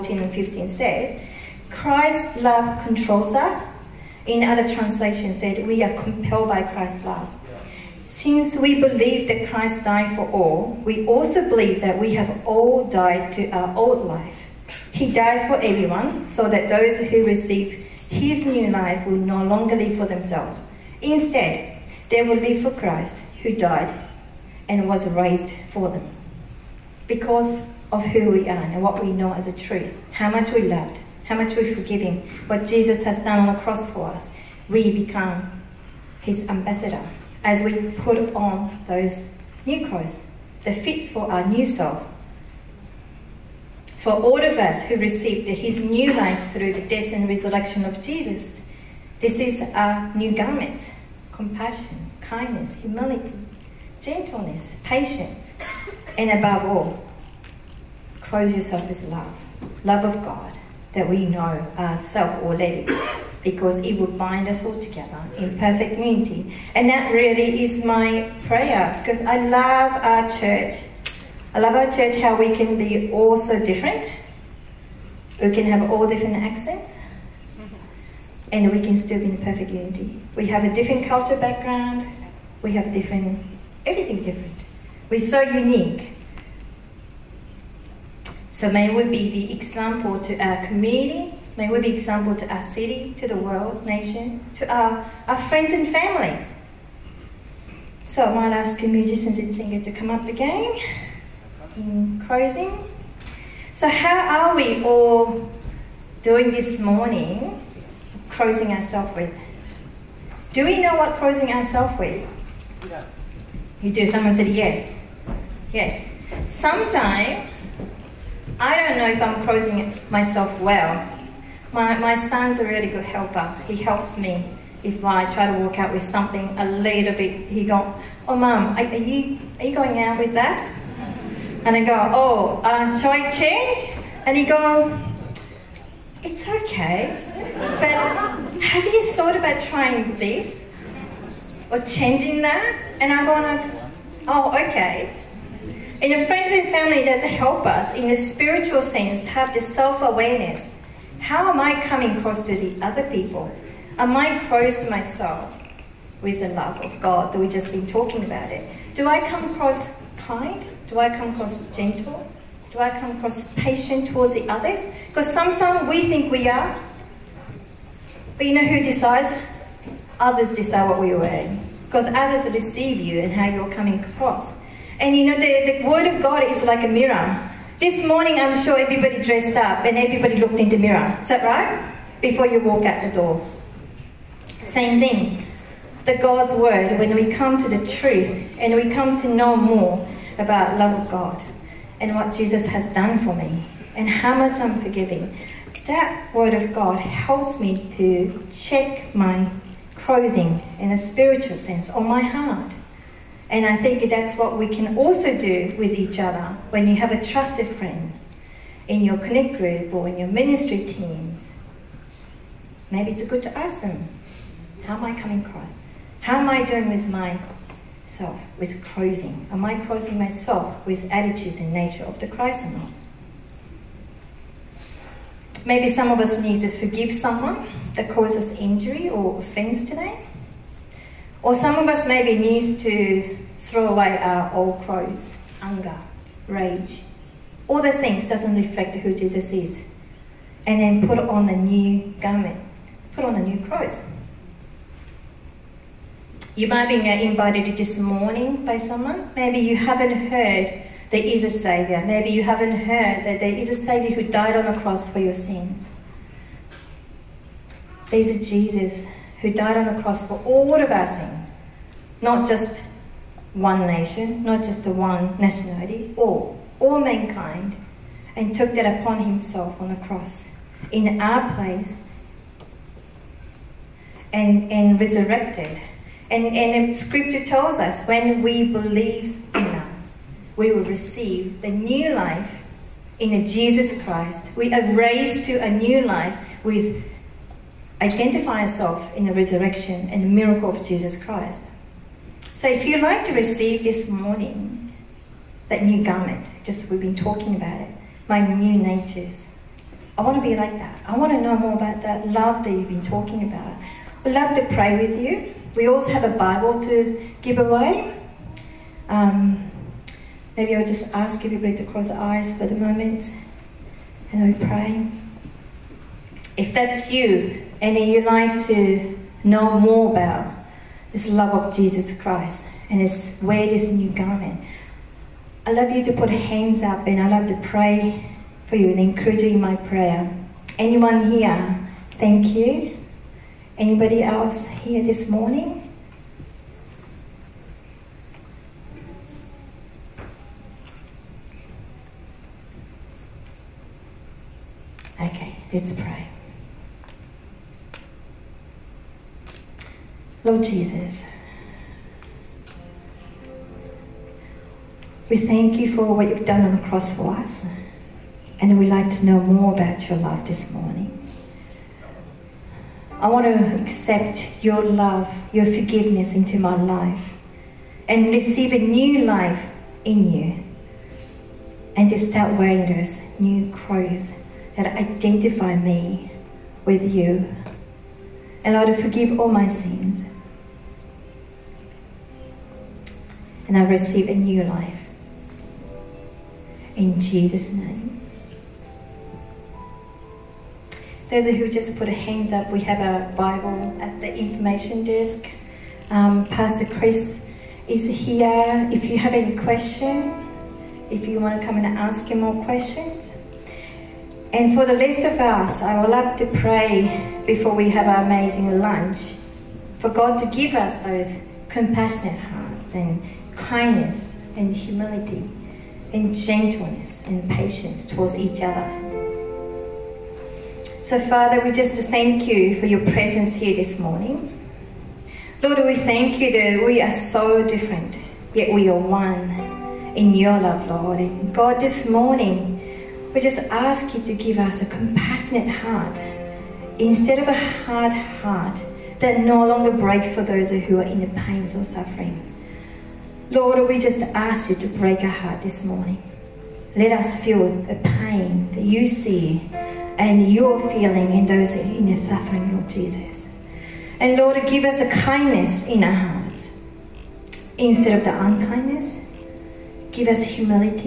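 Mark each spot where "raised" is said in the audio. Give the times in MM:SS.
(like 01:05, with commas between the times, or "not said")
00:25, 04:44.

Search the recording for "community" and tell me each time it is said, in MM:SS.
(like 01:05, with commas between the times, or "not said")
01:30.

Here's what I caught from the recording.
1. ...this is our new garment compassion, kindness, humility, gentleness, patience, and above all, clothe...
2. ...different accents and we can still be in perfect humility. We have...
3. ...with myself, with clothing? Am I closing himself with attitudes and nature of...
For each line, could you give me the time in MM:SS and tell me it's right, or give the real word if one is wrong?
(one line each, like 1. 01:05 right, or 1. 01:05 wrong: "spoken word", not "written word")
1. 00:49 right
2. 01:16 wrong: "unity", not "humility"
3. 03:36 wrong: "myself", not "himself".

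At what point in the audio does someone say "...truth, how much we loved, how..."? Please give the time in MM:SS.
00:29.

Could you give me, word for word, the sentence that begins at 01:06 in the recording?
And that really is my prayer because I love our church.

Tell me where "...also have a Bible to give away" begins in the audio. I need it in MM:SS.
05:05.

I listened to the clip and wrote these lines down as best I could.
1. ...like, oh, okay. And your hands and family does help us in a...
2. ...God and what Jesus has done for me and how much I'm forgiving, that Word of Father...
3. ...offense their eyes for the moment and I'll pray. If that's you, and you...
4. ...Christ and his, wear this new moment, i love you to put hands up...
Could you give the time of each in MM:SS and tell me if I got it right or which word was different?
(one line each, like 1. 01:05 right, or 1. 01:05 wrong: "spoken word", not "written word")
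1. 02:23 wrong: "friends", not "hands"
2. 03:11 wrong: "God", not "Father"
3. 05:11 wrong: "close", not "offense"
4. 05:22 wrong: "garment", not "moment".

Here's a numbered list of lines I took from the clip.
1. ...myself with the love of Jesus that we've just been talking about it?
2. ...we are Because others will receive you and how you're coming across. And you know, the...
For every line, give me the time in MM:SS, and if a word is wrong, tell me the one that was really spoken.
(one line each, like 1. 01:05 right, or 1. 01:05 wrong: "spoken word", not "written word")
1. 02:34 wrong: "God", not "Jesus"
2. 02:51 right.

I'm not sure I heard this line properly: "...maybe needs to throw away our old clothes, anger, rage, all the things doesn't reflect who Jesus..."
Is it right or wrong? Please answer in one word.
right.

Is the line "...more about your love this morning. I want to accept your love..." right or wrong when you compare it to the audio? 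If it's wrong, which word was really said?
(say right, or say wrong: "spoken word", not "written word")
right.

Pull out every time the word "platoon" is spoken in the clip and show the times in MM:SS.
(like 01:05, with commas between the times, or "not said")
not said.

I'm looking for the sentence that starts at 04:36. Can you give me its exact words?
And, and scripture tells us when we believe in him, we will receive the new life in Jesus Christ.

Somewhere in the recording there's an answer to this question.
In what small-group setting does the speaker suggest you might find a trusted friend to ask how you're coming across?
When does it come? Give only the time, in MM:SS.
03:29.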